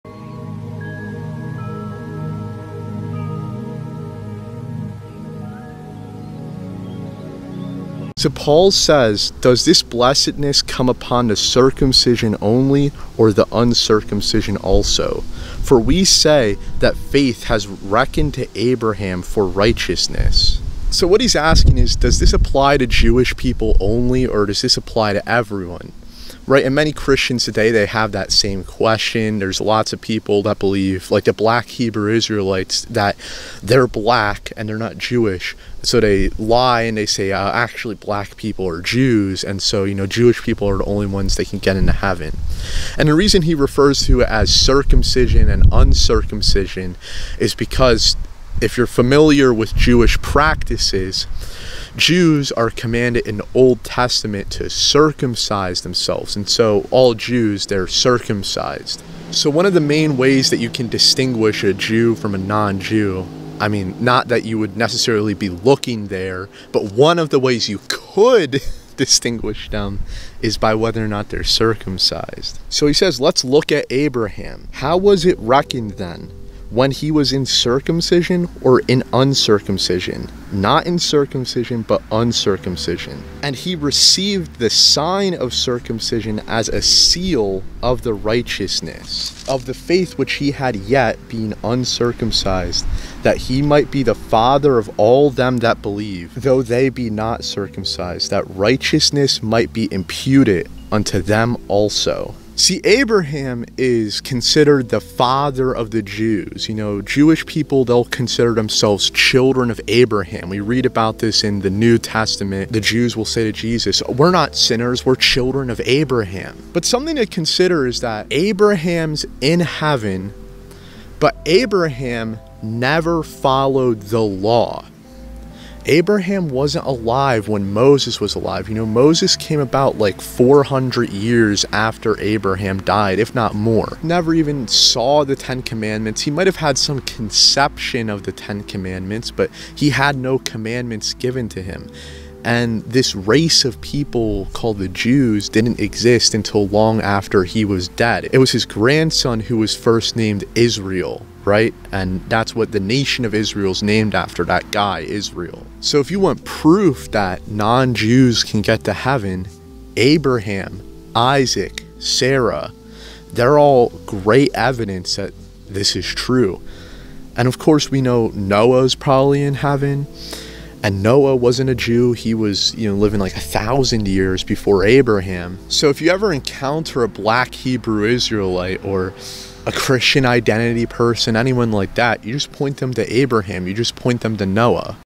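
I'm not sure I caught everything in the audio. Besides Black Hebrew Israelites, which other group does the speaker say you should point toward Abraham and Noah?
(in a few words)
Christian identity.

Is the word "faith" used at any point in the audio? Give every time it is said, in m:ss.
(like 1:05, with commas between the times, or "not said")
0:16, 1:29.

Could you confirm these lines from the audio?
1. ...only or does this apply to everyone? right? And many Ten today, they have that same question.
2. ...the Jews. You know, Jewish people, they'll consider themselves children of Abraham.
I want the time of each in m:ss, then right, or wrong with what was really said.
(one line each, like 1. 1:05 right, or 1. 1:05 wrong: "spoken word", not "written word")
1. 0:23 wrong: "Christians", not "Ten"
2. 1:45 right.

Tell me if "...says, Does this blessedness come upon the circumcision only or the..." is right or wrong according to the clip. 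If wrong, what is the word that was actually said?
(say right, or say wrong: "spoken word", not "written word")
right.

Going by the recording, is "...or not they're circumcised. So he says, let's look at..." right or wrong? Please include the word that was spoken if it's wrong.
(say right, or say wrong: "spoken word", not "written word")
right.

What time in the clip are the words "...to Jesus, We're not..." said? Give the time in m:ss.
1:53.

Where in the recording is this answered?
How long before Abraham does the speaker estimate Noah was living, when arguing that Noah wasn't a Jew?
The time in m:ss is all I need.
2:53.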